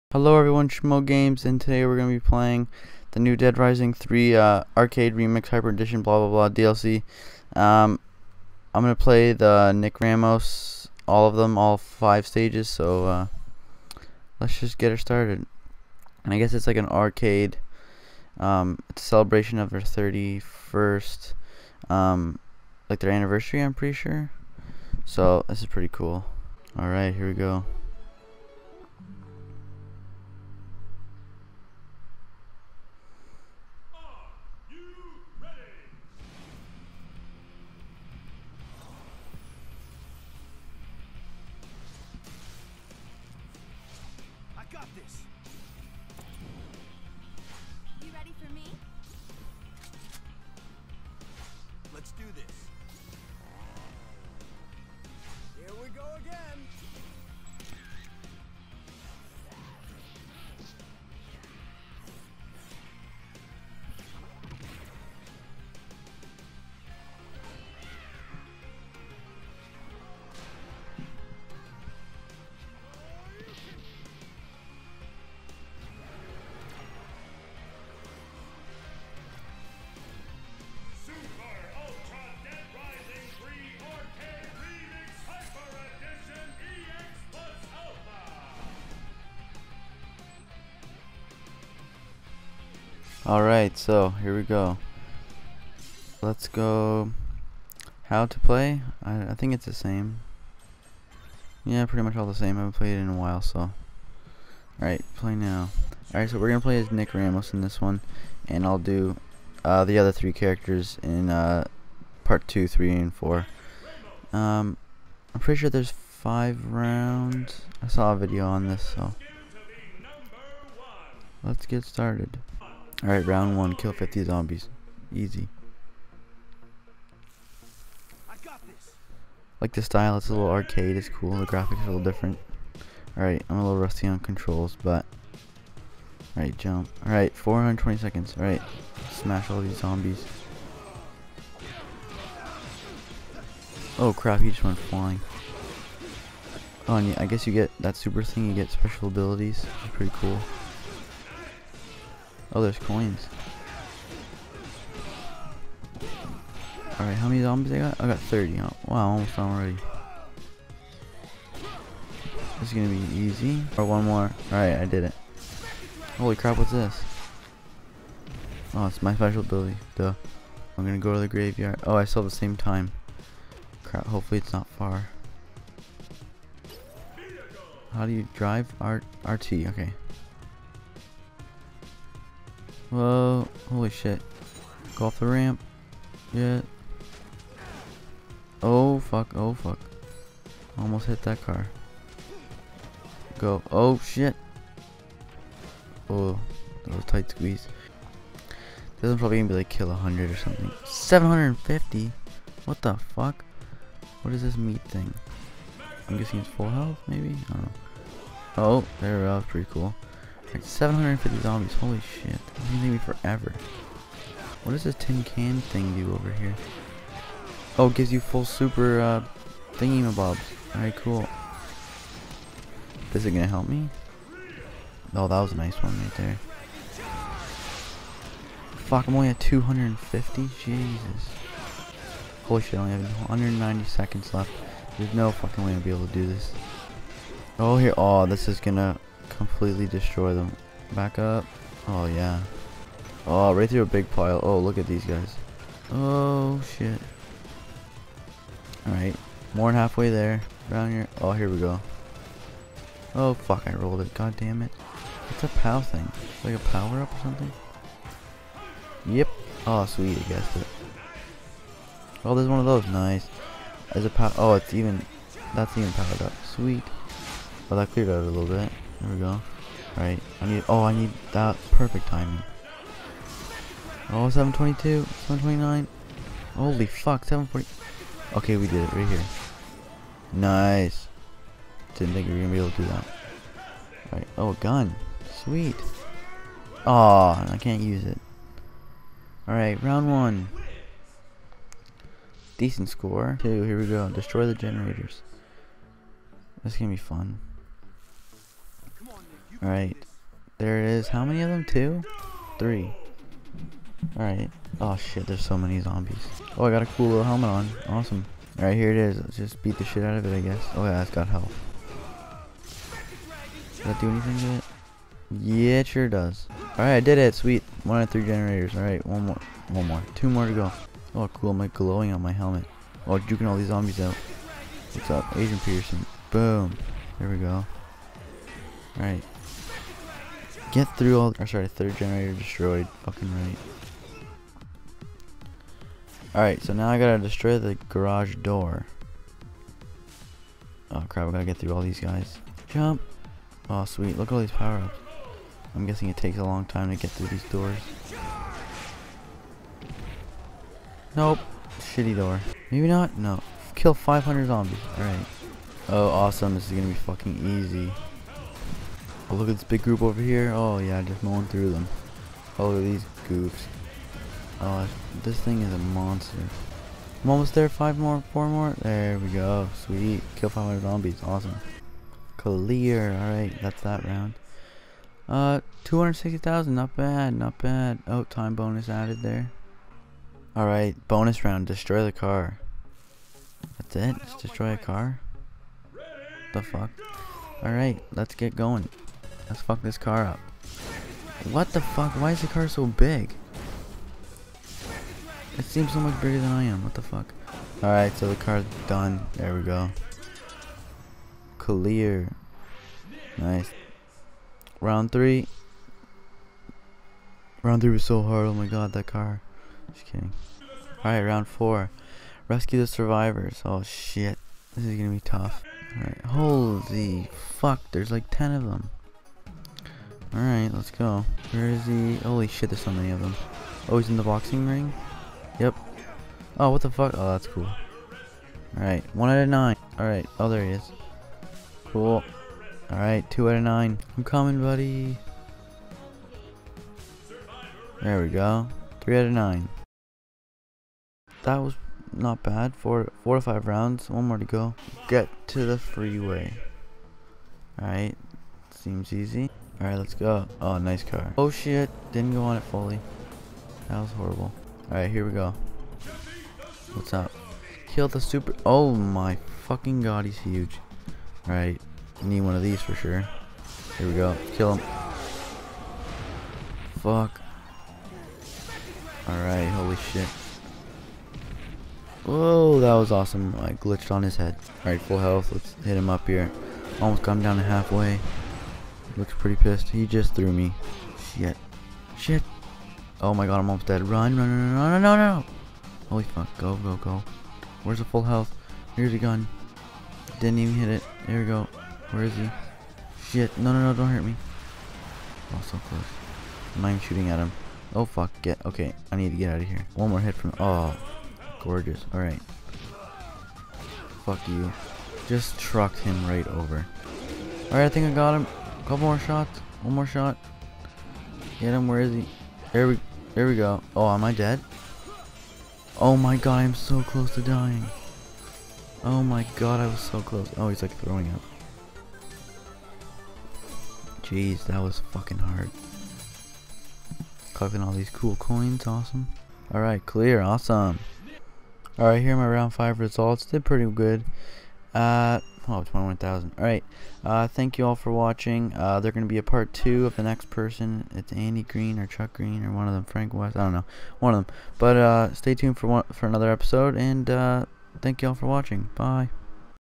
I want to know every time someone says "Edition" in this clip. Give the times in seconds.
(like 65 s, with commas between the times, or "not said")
5 s.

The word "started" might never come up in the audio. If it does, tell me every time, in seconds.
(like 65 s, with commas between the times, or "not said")
14 s, 121 s.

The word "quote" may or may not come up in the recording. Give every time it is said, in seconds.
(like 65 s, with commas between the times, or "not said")
not said.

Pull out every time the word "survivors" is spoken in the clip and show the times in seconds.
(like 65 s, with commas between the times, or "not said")
412 s.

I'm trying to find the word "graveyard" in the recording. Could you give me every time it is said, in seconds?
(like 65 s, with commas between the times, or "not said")
171 s.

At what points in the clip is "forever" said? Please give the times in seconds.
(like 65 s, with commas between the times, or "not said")
212 s.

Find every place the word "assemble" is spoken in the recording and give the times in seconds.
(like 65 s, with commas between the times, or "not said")
not said.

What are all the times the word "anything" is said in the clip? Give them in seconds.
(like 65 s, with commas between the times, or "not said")
314 s.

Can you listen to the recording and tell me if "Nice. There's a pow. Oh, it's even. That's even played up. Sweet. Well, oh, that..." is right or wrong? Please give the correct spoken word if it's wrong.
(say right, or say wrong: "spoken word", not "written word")
wrong: "powered", not "played".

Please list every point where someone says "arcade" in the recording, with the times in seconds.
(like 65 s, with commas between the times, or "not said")
4 s, 16 s, 130 s.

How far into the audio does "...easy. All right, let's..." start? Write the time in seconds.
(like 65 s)
449 s.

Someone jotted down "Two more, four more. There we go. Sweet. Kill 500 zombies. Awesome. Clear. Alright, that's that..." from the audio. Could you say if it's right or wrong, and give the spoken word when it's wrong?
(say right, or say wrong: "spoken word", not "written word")
wrong: "Five", not "Two".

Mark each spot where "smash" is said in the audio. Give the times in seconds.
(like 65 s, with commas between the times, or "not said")
139 s.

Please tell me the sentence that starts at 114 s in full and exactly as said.
Um, I'm pretty sure there's five rounds.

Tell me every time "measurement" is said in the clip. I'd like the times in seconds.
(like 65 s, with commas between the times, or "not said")
not said.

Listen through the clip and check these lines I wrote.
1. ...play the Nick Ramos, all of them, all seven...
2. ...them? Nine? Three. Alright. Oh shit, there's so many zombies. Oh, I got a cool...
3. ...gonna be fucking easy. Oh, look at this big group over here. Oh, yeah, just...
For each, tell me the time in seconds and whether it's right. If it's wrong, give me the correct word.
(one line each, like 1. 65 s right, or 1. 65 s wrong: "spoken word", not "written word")
1. 9 s wrong: "five", not "seven"
2. 301 s wrong: "Two", not "Nine"
3. 356 s right.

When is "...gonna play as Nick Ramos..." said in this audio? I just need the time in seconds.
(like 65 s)
106 s.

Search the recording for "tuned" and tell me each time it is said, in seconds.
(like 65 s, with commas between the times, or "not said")
545 s.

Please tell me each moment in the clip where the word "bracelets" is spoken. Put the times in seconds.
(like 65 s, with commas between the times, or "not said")
not said.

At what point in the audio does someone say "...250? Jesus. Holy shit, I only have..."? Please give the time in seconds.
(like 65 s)
229 s.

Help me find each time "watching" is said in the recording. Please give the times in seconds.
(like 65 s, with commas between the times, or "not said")
538 s, 548 s.